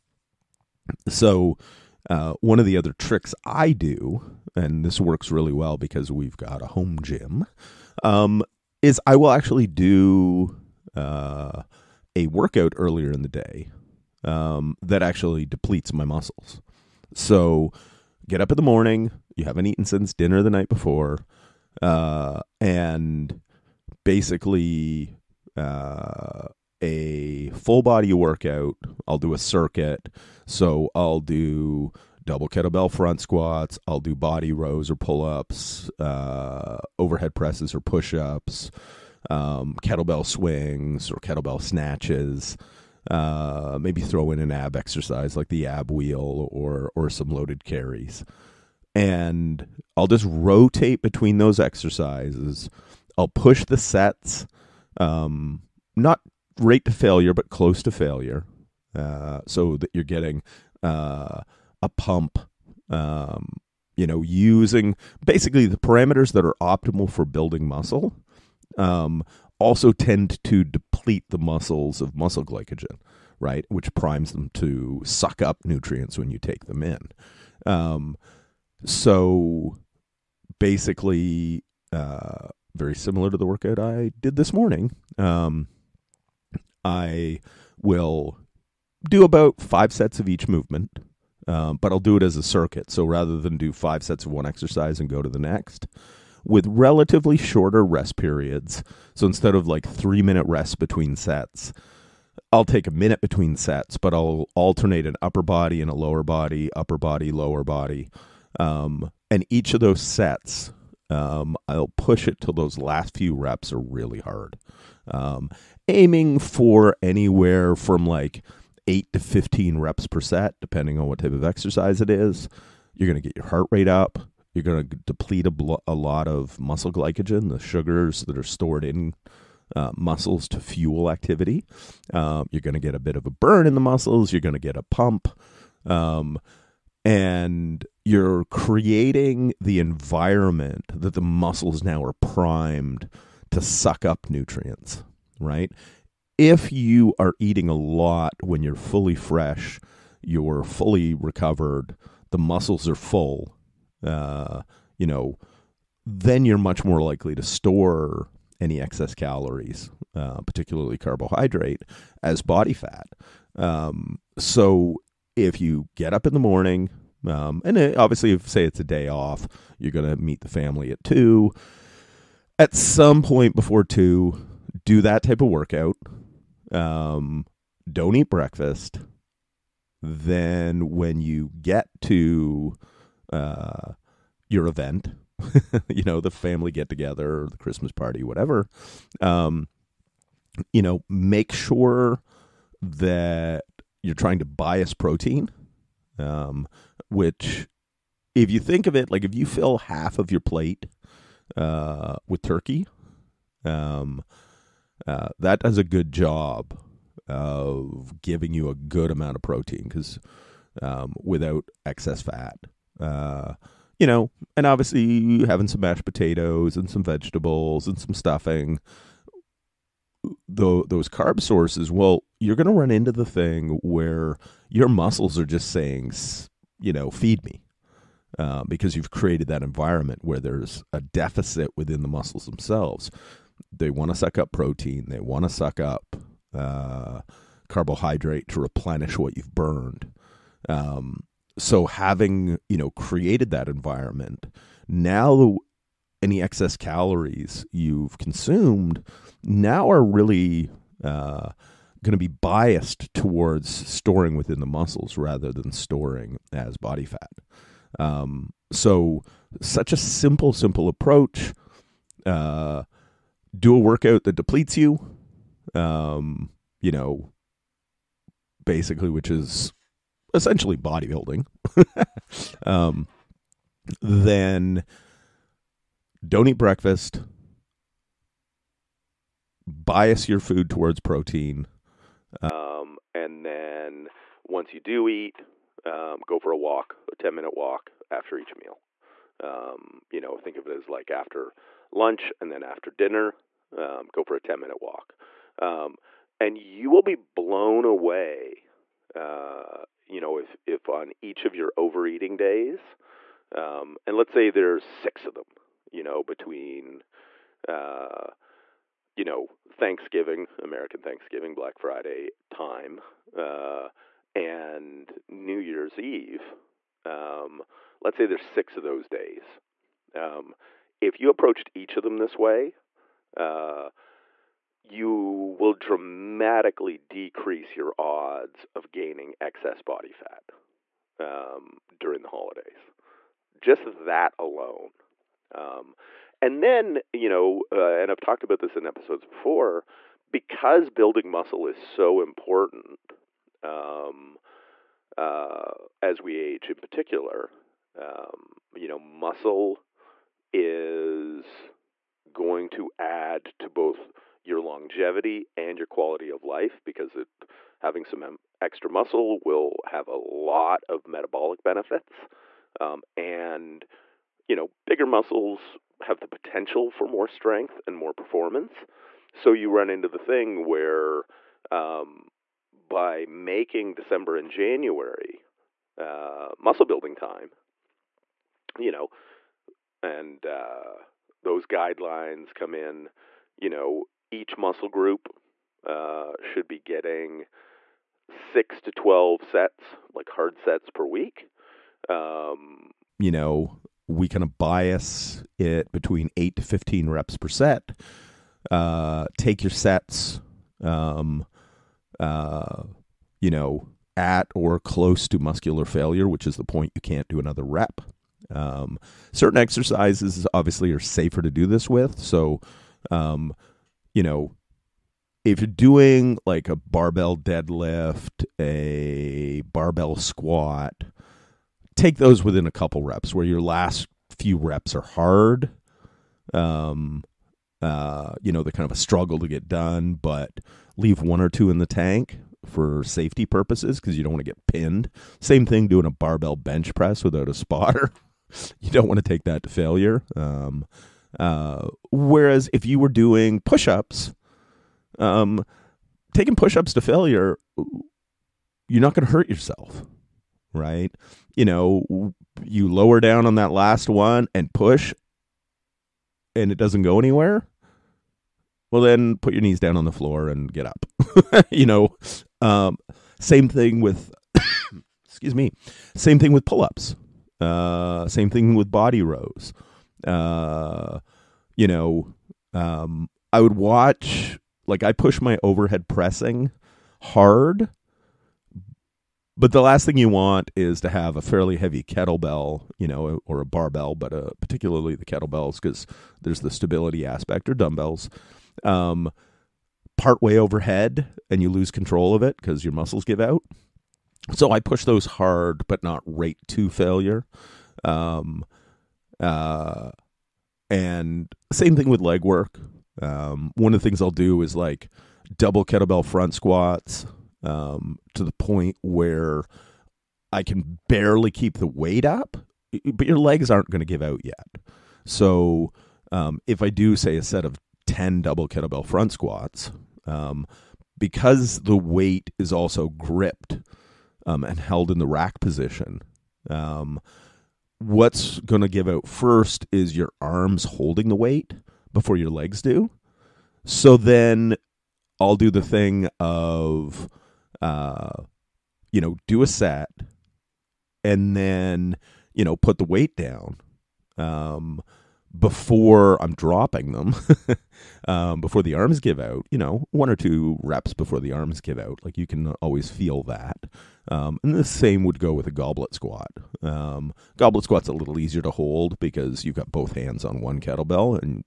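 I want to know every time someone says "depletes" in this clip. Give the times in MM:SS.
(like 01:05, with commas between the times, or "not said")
00:15, 01:10, 02:05, 04:24.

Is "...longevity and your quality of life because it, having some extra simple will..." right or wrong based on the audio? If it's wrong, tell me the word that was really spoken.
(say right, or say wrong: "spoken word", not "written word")
wrong: "muscle", not "simple".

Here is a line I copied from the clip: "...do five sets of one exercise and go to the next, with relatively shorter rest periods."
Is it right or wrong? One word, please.
right.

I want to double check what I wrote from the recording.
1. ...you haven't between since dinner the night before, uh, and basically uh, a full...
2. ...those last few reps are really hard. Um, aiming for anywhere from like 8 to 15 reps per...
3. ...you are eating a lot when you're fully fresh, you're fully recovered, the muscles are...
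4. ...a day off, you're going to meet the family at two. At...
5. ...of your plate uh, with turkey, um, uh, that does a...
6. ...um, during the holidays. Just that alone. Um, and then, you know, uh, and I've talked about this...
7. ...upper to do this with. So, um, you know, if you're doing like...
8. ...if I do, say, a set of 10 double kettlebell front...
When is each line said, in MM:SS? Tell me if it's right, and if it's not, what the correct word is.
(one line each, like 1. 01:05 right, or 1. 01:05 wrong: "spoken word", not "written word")
1. 00:19 wrong: "eaten", not "between"
2. 01:52 right
3. 02:26 right
4. 02:48 right
5. 03:20 right
6. 05:31 right
7. 06:50 wrong: "safer", not "upper"
8. 08:36 right.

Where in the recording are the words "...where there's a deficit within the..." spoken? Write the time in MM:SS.
03:50.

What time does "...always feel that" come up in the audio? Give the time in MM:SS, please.
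09:12.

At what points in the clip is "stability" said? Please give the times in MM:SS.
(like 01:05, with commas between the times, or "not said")
08:06.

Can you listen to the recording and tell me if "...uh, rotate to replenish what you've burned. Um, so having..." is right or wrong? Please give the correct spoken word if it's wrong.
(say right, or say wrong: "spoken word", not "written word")
wrong: "carbohydrate", not "rotate".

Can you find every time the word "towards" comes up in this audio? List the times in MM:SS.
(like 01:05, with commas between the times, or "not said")
04:13, 04:40.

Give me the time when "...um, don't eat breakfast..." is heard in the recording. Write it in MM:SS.
02:56.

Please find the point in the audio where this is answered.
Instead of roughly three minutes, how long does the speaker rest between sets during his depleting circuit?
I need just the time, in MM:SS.
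01:42.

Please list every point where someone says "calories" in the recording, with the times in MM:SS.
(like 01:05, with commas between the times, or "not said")
02:39, 04:06.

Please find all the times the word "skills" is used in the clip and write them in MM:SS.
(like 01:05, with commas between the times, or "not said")
not said.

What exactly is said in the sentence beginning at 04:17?
Um, so, such a simple, simple approach.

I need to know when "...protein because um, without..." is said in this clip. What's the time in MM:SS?
03:29.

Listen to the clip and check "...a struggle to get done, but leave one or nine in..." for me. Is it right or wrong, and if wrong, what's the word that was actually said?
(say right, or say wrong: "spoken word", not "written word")
wrong: "two", not "nine".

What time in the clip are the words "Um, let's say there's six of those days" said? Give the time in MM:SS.
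05:17.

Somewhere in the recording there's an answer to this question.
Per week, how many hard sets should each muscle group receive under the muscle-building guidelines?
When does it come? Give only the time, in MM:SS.
06:28.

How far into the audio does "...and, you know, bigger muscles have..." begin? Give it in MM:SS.
06:03.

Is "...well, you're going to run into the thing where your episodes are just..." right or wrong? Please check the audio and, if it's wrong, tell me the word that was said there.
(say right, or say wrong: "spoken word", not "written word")
wrong: "muscles", not "episodes".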